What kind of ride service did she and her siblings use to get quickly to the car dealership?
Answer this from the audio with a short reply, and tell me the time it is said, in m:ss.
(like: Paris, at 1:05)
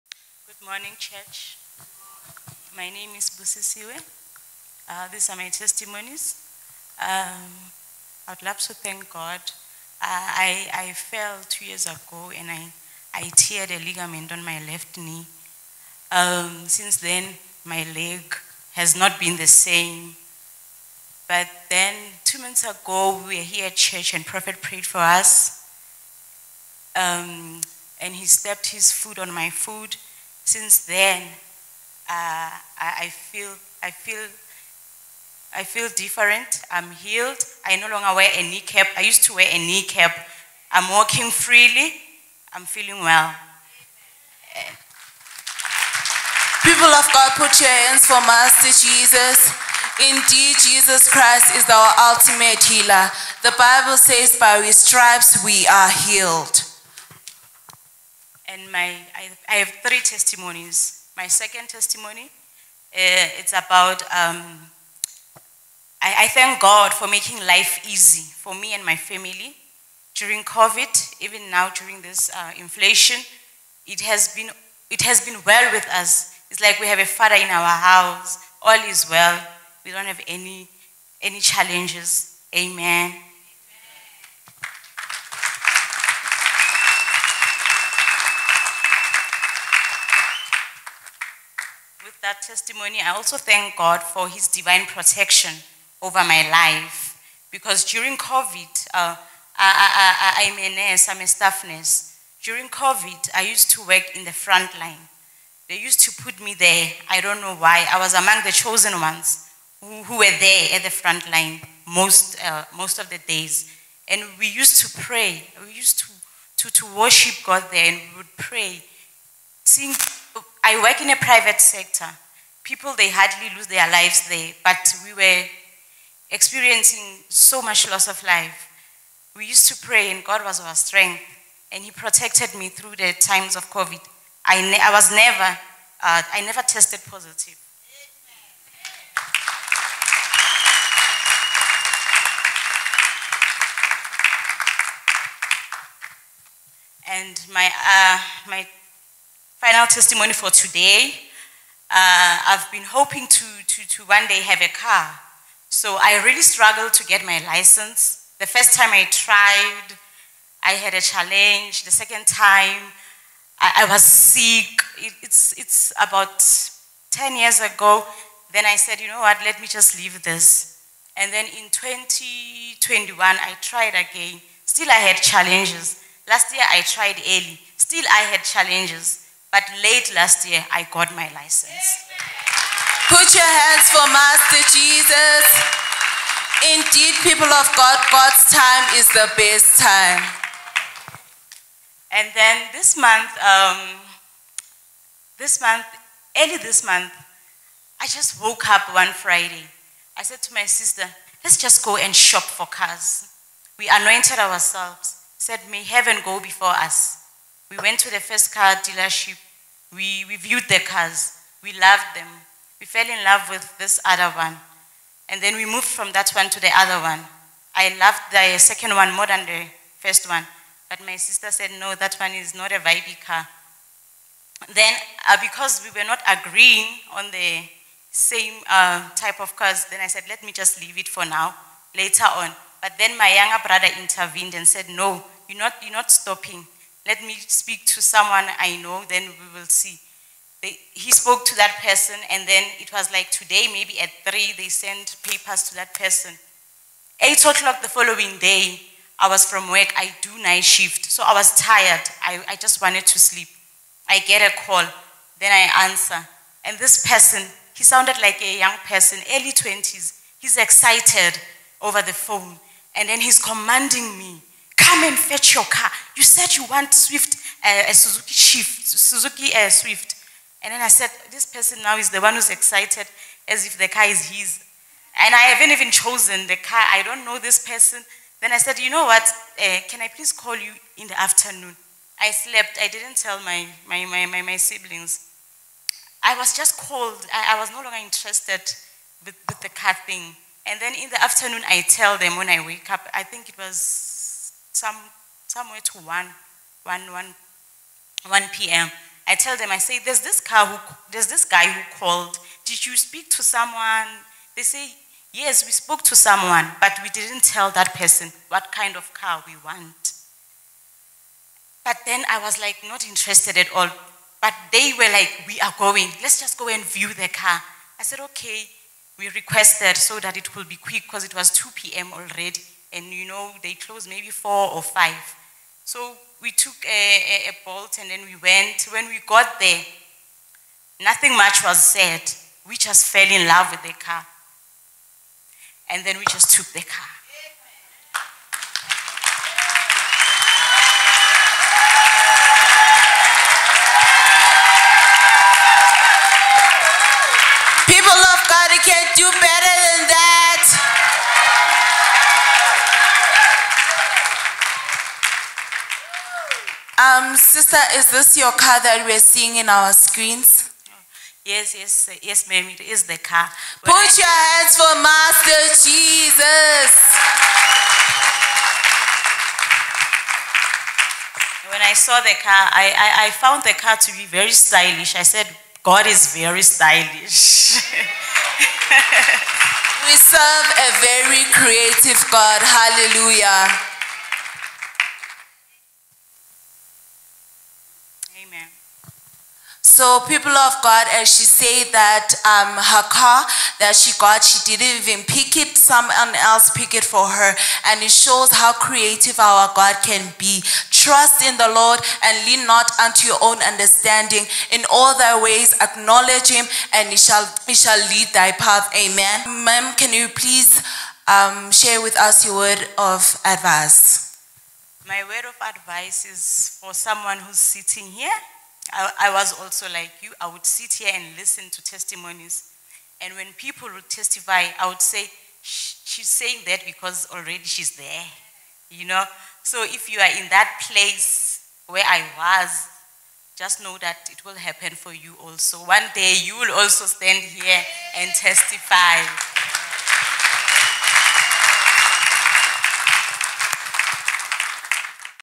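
Bolt, at 5:27.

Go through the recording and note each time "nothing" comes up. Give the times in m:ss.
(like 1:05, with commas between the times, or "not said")
5:31.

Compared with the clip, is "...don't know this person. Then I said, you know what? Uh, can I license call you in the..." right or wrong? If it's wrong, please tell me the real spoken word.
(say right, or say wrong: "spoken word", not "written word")
wrong: "please", not "license".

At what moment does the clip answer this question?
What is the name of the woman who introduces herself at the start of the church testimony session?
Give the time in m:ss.
0:03.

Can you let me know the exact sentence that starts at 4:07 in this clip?
Eight o'clock the following day, I was from work.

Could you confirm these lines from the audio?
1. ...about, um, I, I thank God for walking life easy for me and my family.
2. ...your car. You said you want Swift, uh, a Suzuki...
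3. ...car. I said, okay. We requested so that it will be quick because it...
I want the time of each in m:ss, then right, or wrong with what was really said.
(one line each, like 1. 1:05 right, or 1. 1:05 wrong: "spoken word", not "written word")
1. 1:03 wrong: "making", not "walking"
2. 4:25 right
3. 5:17 right.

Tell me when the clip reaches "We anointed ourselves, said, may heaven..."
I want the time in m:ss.
3:23.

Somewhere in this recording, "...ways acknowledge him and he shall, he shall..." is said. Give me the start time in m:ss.
6:45.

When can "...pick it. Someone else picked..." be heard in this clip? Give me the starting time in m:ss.
6:35.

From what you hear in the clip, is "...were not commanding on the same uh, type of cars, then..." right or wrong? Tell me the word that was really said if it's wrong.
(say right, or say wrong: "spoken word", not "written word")
wrong: "agreeing", not "commanding".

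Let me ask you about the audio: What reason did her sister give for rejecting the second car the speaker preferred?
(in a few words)
not a vibey car.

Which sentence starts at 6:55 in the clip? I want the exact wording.
My word of advice is for someone who's sitting here I, I was also like you.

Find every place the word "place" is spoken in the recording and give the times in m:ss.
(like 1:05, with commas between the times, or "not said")
7:10.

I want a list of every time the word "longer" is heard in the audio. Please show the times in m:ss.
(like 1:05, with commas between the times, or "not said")
0:37, 4:47.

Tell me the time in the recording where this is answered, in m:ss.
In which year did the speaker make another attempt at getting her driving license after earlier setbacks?
2:51.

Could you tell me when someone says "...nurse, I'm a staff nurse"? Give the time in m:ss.
1:40.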